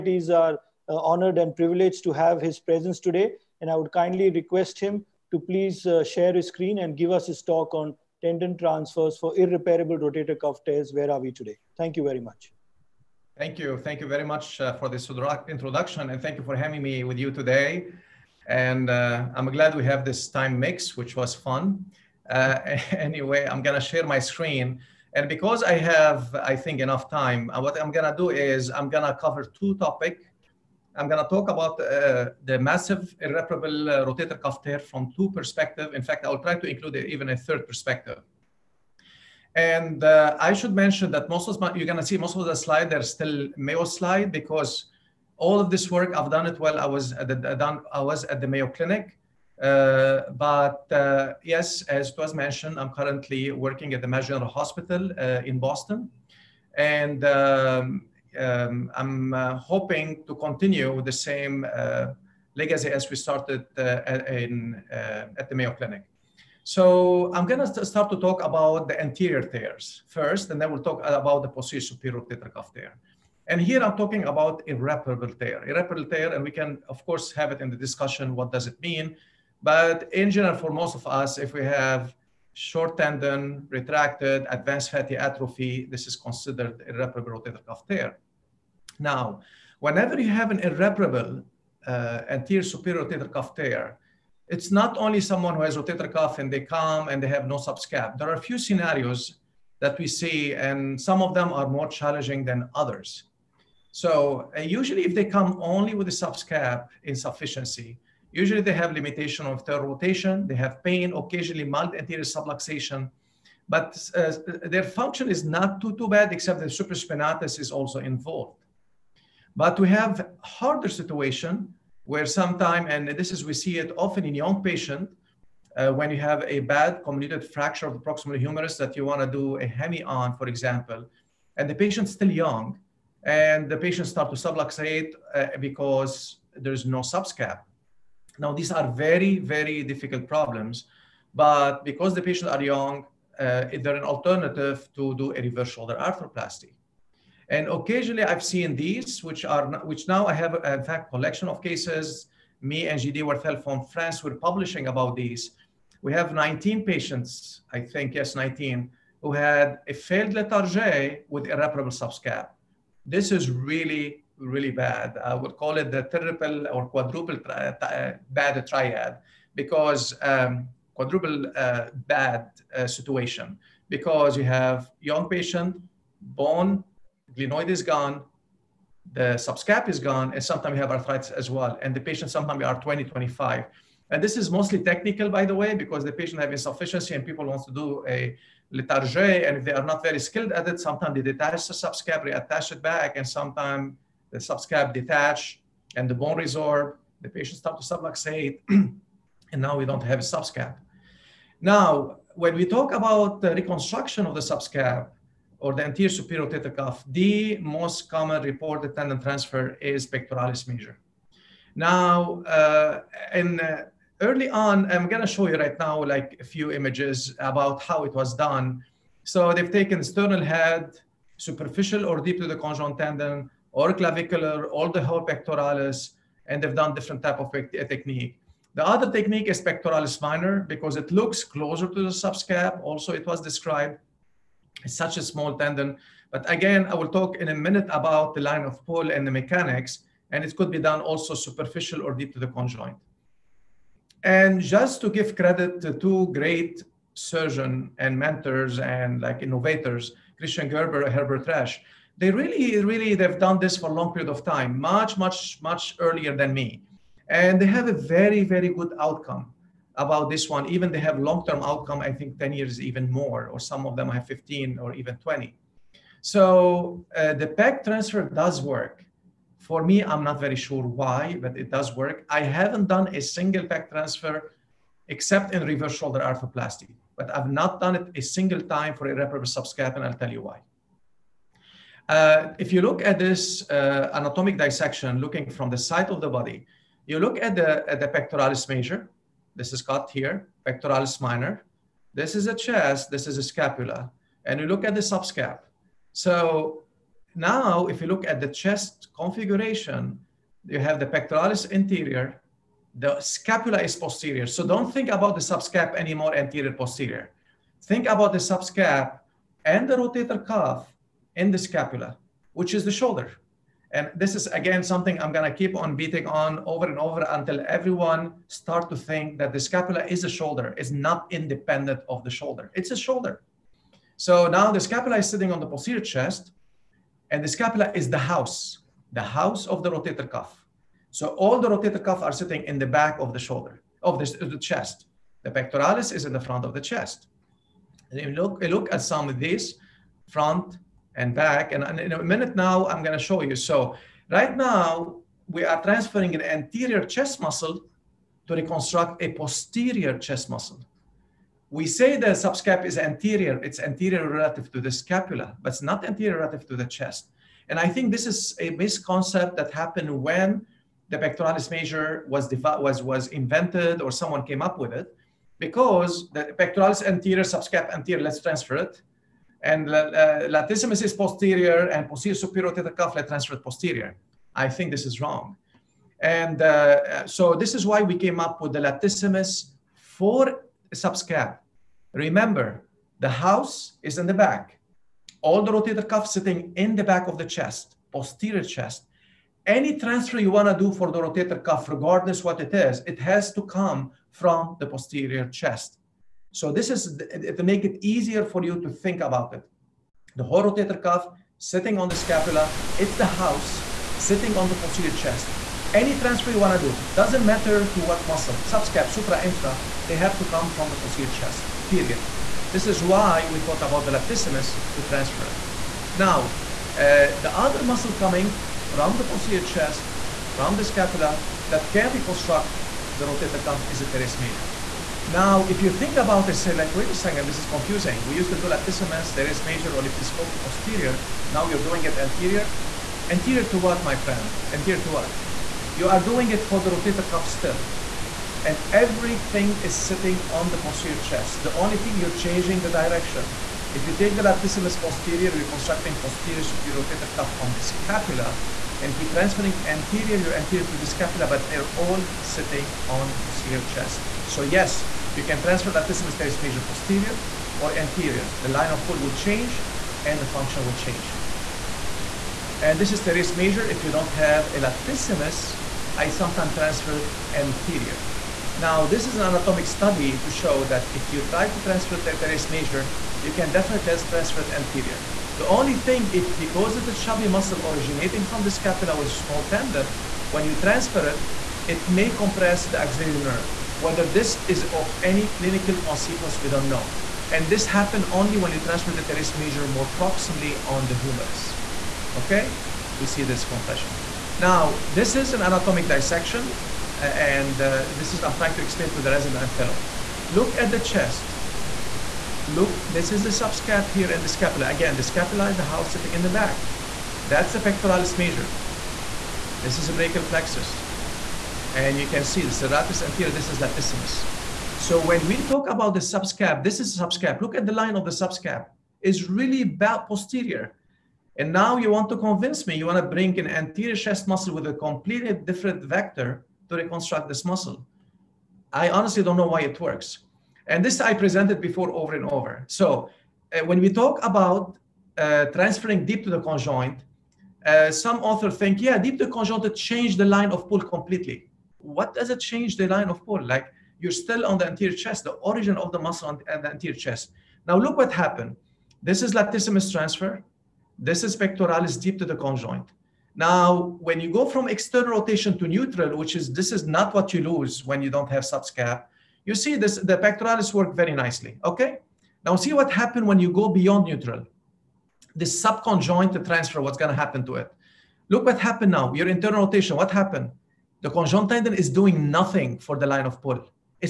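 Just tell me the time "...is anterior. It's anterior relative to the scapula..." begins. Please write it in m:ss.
5:52.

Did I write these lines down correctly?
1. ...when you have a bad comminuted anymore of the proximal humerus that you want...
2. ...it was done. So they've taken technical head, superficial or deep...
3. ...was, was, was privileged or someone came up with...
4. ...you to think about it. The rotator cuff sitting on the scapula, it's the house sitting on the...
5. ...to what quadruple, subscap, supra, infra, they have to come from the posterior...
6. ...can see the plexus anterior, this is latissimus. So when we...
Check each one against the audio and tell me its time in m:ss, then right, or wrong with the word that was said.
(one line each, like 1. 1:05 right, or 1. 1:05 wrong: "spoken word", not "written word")
1. 2:05 wrong: "fracture", not "anymore"
2. 3:38 wrong: "sternal", not "technical"
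3. 6:02 wrong: "invented", not "privileged"
4. 6:38 right
5. 6:47 wrong: "muscle", not "quadruple"
6. 8:32 wrong: "serratus", not "plexus".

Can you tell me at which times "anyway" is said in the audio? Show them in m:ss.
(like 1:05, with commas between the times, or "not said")
0:22.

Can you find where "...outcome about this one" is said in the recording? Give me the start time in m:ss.
4:18.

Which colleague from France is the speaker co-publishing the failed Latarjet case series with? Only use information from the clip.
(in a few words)
JD Werthel.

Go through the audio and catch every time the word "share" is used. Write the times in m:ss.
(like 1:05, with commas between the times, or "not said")
0:06, 0:23.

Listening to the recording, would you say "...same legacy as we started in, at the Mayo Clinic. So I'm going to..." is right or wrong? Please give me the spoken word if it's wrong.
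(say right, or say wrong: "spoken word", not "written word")
right.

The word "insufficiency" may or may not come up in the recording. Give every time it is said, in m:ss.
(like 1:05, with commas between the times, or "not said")
1:47, 3:06.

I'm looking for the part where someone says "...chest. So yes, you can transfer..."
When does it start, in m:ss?
7:33.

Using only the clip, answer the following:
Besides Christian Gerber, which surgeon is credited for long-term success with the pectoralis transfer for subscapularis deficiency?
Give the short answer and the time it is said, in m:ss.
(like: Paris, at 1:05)
Herbert Resch, at 4:11.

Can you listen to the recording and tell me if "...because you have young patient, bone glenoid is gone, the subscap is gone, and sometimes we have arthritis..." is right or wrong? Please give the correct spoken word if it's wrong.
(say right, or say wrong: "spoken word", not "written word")
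right.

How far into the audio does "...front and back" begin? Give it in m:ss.
5:40.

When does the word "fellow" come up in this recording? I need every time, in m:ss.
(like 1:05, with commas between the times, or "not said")
8:19.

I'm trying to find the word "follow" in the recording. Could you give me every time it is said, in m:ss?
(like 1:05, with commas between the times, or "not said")
not said.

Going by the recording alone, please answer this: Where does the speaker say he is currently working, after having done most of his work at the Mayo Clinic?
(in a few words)
Mayo General Hospital.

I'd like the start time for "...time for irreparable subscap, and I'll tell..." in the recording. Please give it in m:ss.
4:38.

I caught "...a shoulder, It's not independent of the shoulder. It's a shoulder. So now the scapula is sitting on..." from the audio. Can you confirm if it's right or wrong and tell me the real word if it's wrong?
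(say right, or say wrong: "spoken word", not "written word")
right.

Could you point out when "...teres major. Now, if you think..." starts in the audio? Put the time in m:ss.
7:04.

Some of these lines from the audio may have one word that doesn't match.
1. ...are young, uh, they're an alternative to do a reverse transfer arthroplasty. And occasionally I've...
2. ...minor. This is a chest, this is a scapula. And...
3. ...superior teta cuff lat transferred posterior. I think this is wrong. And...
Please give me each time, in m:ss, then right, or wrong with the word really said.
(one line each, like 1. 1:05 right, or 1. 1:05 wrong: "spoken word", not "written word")
1. 2:22 wrong: "shoulder", not "transfer"
2. 4:51 right
3. 6:12 right.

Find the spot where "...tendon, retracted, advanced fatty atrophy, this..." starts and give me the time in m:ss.
1:22.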